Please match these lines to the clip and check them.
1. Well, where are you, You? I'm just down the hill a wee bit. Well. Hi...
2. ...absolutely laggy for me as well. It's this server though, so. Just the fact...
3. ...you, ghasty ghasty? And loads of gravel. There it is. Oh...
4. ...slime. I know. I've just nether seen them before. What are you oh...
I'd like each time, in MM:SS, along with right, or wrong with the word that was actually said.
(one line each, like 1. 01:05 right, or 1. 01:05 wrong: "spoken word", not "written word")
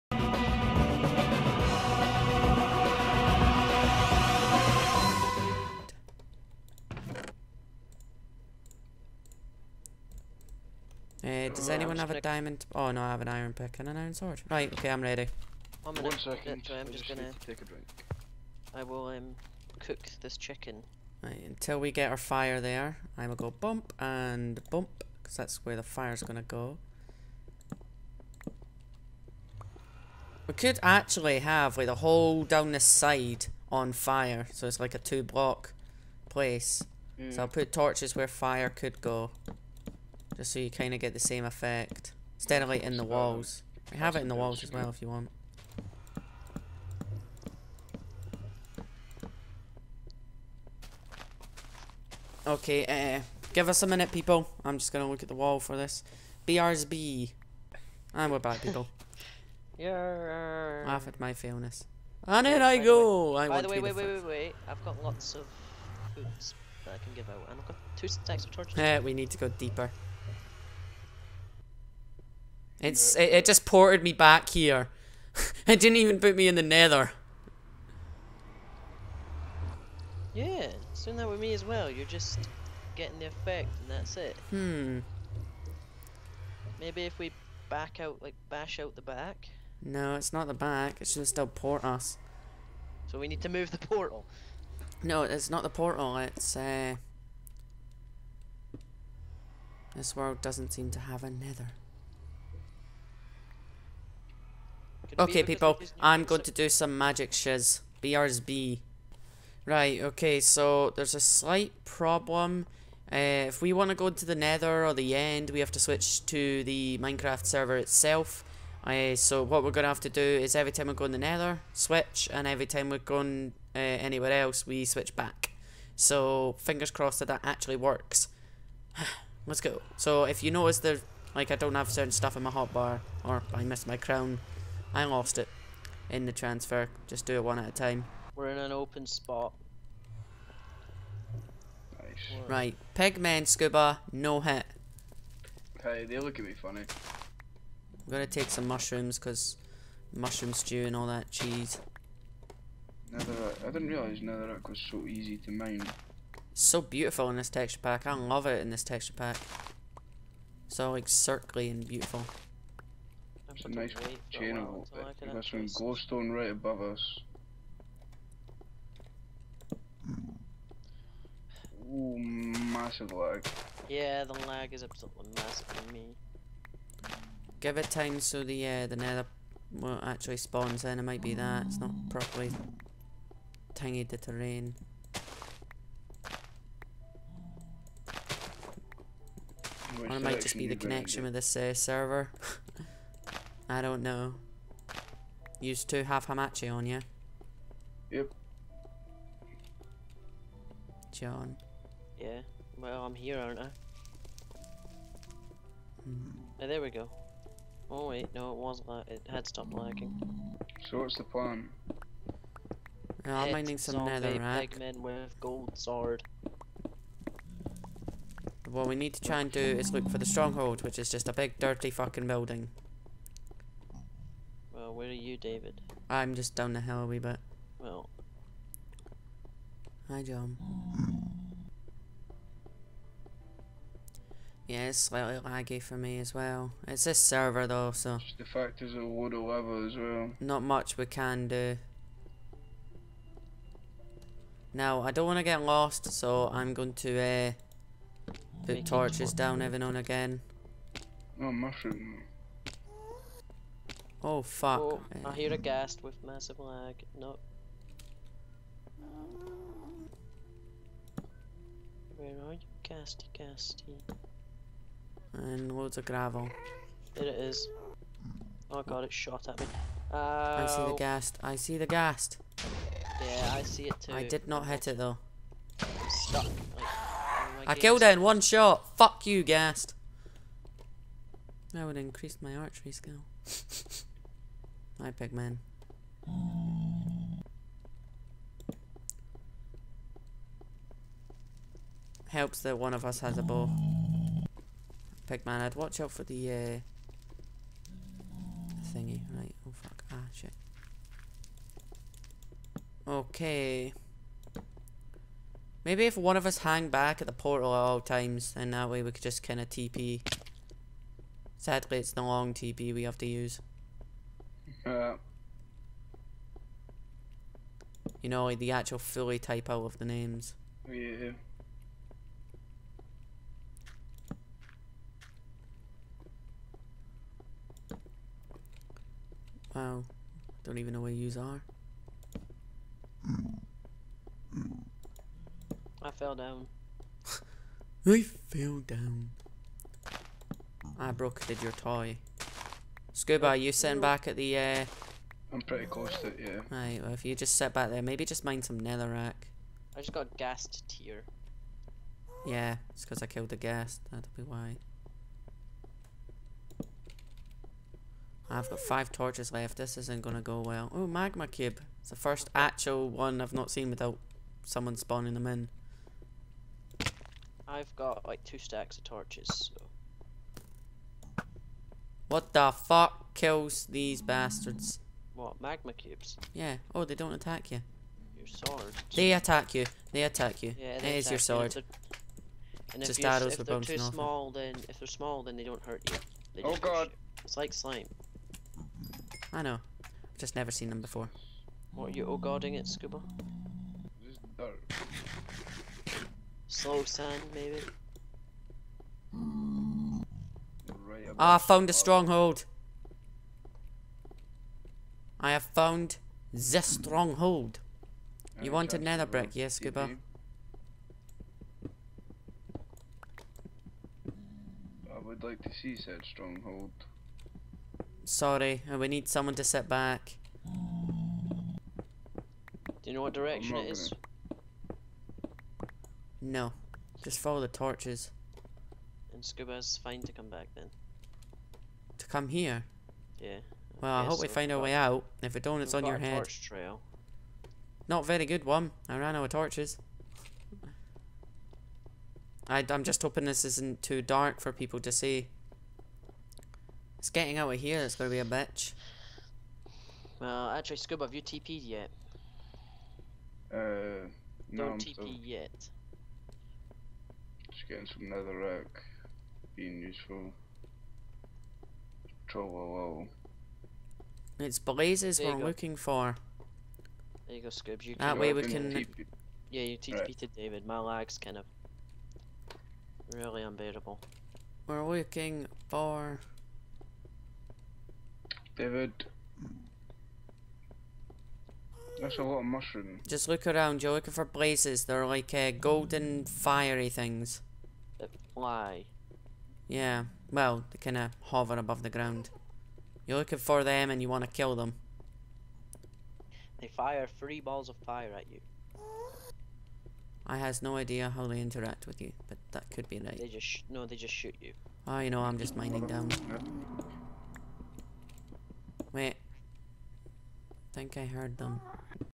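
1. 03:44 wrong: "David", not "You"
2. 03:54 wrong: "slightly", not "absolutely"
3. 04:22 right
4. 06:27 wrong: "never", not "nether".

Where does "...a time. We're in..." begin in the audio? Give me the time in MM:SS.
02:17.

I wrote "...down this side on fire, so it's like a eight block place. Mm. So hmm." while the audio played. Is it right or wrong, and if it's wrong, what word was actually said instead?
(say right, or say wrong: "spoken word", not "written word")
wrong: "two", not "eight".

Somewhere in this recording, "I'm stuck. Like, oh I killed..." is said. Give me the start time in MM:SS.
04:35.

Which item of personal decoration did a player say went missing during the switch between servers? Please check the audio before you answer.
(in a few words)
crown.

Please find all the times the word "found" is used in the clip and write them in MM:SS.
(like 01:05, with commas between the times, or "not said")
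06:41, 06:45.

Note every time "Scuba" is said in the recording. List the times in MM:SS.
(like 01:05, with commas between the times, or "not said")
02:23, 05:43, 06:32, 06:49, 07:09, 07:30.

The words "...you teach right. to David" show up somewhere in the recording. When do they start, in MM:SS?
07:49.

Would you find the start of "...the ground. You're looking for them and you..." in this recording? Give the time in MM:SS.
08:12.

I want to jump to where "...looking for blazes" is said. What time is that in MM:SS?
08:04.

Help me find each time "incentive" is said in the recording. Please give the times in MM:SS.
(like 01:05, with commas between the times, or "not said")
not said.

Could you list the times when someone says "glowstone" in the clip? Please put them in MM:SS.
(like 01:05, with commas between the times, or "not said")
02:46.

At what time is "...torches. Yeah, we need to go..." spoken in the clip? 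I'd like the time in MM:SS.
01:08.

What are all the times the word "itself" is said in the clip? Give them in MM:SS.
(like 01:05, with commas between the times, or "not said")
01:57.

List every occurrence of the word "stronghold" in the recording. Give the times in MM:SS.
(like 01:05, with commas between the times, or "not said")
03:40, 06:41, 06:46, 06:56.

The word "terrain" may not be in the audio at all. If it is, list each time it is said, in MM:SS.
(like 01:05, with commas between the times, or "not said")
03:04.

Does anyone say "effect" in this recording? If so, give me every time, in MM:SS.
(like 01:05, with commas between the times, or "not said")
00:41, 01:23.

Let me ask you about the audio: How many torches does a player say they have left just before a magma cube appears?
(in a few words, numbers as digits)
5.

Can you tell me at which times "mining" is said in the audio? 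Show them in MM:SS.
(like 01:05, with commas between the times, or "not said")
03:33, 08:25.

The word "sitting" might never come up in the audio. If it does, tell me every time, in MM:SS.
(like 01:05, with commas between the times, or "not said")
05:43.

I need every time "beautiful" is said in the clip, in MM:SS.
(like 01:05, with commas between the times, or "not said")
02:36, 02:41.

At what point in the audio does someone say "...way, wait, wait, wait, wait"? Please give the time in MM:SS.
01:03.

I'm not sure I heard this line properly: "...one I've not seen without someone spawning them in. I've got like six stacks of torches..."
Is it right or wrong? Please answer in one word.
wrong.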